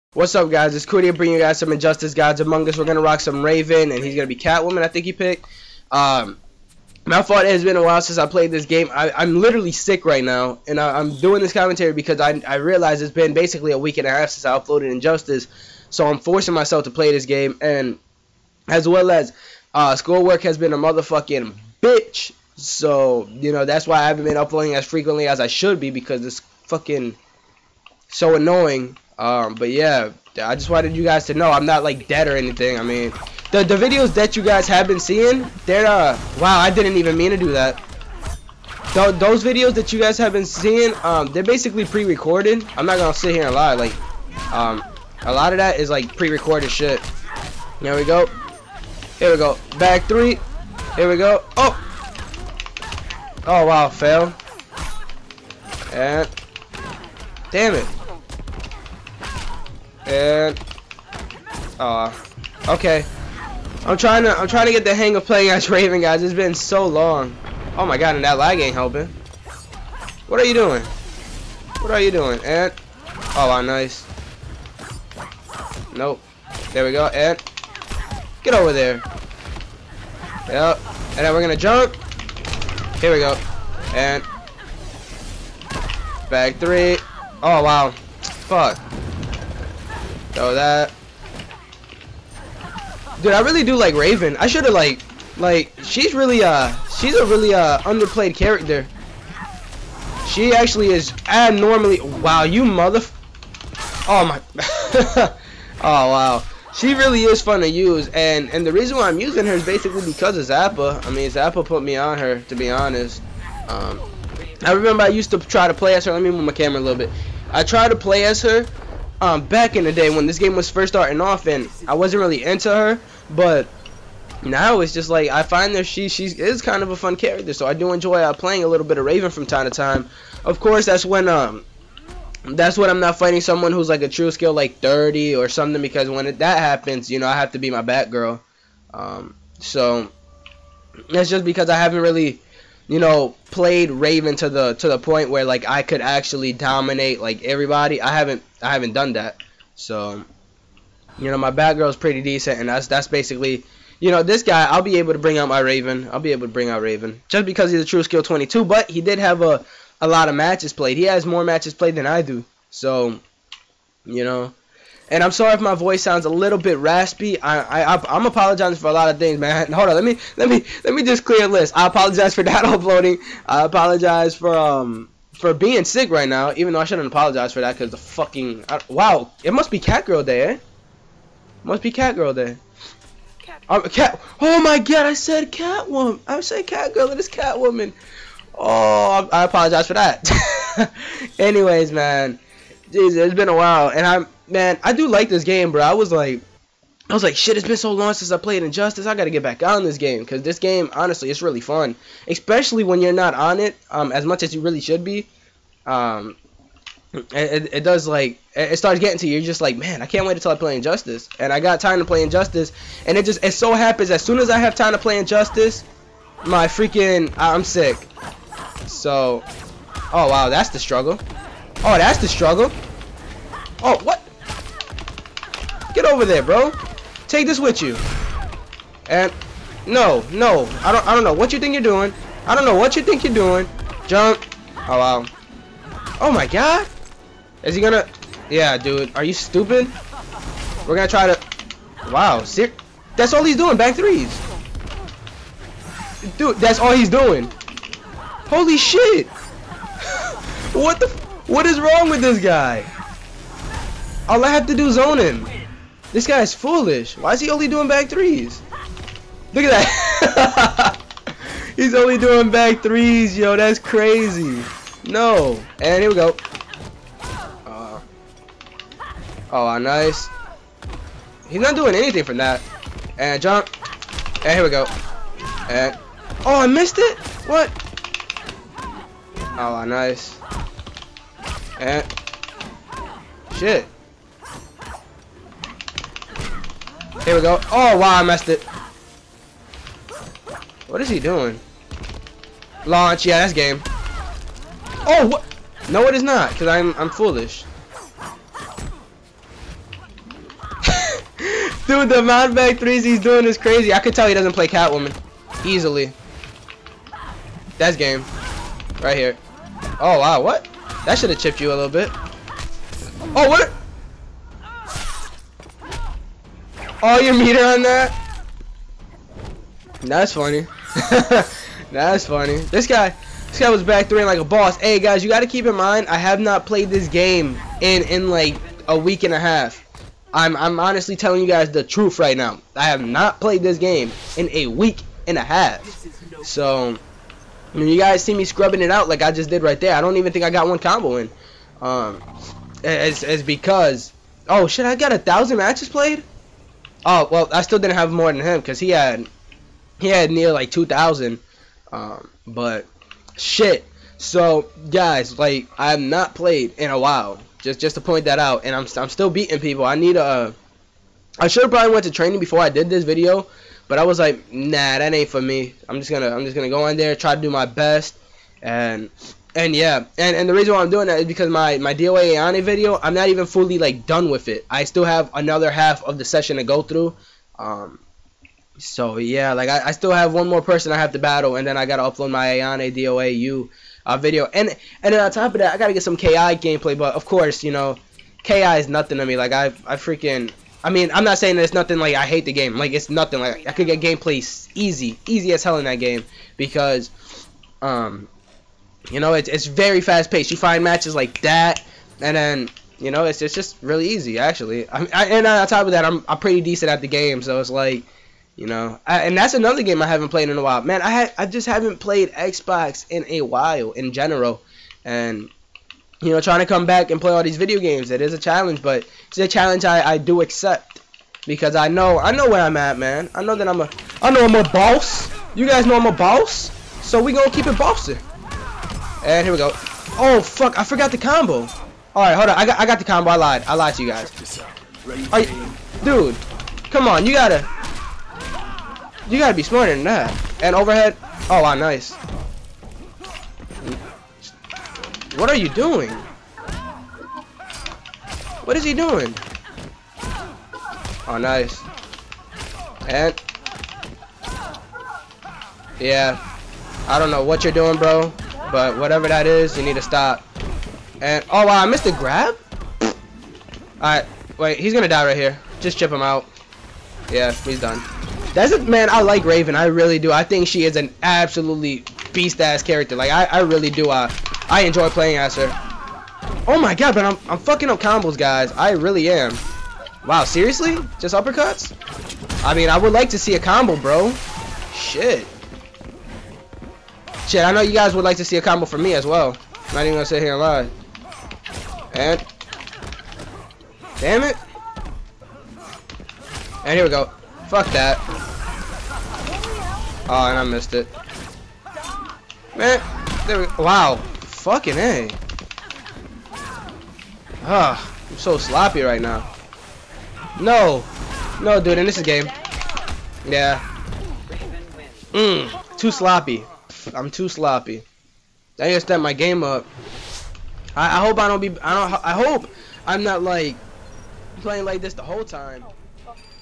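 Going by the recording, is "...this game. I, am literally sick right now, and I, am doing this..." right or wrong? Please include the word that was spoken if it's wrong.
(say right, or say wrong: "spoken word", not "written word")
right.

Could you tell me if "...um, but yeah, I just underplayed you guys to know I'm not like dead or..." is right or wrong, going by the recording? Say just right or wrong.
wrong.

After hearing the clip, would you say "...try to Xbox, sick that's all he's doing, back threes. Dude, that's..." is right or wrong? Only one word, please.
wrong.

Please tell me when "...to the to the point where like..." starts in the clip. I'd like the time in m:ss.
2:24.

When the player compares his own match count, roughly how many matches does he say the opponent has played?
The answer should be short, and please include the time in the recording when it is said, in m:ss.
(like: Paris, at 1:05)
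2,000, at 5:50.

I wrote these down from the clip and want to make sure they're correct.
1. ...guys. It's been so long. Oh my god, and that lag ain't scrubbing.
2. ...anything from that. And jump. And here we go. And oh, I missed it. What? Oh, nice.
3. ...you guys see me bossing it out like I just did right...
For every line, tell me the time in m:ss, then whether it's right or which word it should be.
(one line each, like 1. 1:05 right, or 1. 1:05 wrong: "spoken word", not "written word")
1. 1:06 wrong: "helping", not "scrubbing"
2. 4:31 right
3. 5:37 wrong: "scrubbing", not "bossing".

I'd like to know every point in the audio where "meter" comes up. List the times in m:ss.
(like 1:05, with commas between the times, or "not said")
5:17.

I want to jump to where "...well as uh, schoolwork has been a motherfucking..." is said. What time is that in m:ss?
0:18.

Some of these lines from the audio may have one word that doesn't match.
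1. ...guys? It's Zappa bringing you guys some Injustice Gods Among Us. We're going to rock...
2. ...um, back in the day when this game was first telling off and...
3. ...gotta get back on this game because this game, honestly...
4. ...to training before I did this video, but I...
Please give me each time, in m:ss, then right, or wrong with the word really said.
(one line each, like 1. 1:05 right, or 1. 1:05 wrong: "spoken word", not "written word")
1. 0:00 wrong: "Cootie", not "Zappa"
2. 1:59 wrong: "starting", not "telling"
3. 3:19 right
4. 6:02 right.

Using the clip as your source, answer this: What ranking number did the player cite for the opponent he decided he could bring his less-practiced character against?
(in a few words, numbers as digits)
22.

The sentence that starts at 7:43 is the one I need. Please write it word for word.
Alright, wait, he's gonna die right here.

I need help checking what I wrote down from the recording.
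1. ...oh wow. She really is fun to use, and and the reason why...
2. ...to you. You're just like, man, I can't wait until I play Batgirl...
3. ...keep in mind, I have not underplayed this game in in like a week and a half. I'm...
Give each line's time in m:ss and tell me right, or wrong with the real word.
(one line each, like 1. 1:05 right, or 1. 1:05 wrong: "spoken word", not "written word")
1. 1:45 right
2. 3:29 wrong: "Injustice", not "Batgirl"
3. 5:25 wrong: "played", not "underplayed".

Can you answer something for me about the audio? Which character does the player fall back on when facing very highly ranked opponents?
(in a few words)
Batgirl.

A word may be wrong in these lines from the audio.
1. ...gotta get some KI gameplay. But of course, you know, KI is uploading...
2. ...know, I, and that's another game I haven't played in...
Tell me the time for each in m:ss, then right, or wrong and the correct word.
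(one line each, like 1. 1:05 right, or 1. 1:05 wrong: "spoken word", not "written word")
1. 6:25 wrong: "nothing", not "uploading"
2. 6:48 right.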